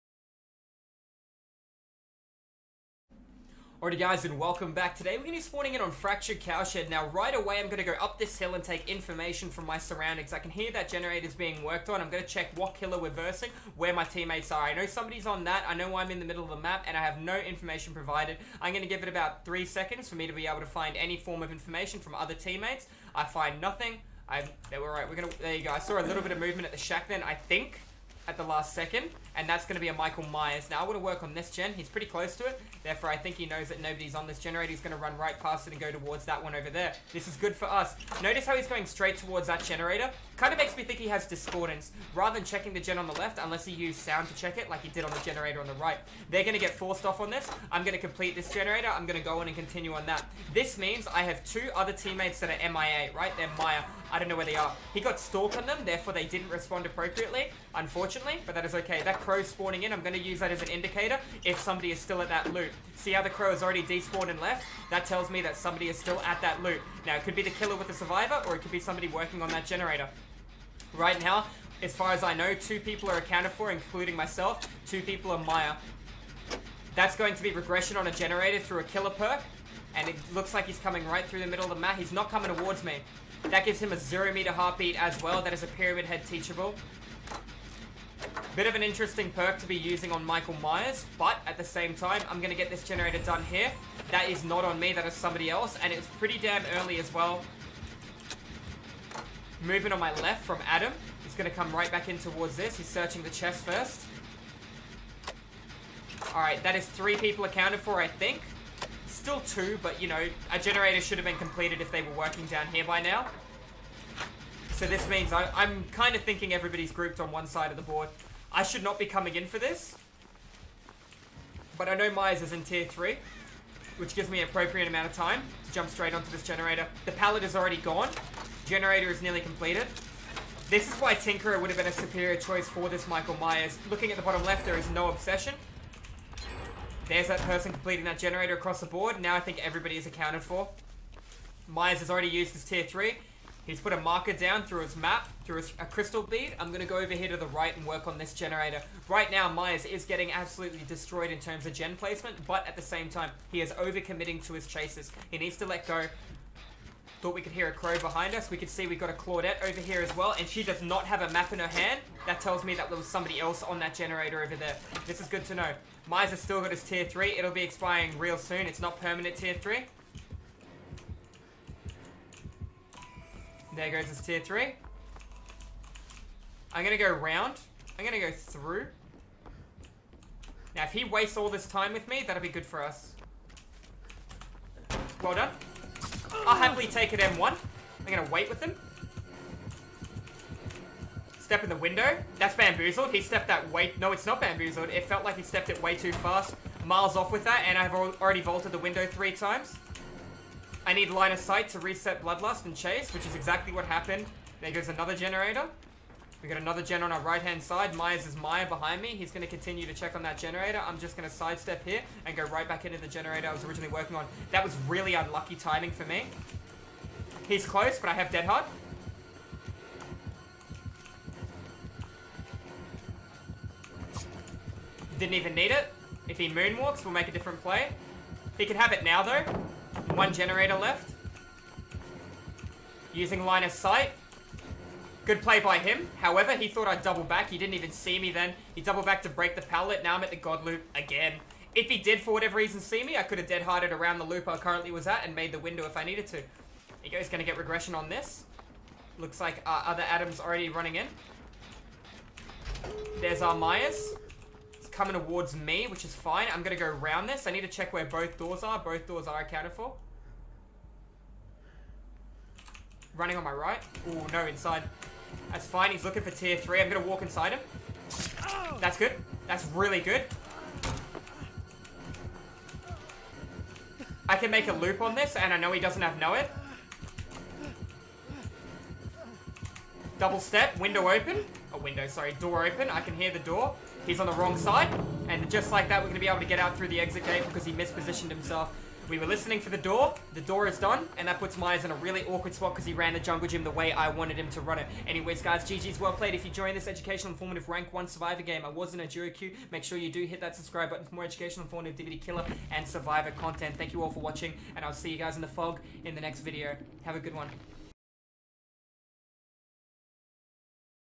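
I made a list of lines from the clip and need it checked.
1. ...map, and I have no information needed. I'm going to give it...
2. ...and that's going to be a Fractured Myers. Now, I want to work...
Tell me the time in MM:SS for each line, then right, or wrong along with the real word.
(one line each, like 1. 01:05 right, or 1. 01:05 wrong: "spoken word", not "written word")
1. 00:16 wrong: "provided", not "needed"
2. 00:29 wrong: "Michael", not "Fractured".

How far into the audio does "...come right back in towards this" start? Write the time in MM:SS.
01:41.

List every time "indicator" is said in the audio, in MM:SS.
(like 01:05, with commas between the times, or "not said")
01:00.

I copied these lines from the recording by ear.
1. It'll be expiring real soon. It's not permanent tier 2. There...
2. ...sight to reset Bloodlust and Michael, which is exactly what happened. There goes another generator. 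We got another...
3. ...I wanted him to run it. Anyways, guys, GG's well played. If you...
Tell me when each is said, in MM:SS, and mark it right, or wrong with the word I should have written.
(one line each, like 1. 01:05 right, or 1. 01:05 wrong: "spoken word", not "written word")
1. 02:47 wrong: "3", not "2"
2. 03:21 wrong: "Chase", not "Michael"
3. 04:53 right.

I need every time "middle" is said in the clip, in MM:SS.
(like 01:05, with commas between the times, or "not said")
00:16, 01:21.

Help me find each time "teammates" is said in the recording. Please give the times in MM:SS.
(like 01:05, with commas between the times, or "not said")
00:14, 00:22, 00:51.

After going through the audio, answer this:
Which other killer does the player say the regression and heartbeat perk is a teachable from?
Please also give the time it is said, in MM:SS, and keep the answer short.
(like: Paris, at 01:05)
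Pyramid Head, at 01:25.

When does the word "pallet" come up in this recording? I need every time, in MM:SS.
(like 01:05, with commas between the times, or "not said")
02:07, 03:59.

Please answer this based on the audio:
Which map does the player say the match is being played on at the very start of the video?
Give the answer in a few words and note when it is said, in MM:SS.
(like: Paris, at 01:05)
Fractured Cowshed, at 00:05.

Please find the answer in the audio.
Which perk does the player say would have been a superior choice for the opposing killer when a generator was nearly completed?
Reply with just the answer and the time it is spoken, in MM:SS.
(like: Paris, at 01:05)
Tinkerer, at 02:11.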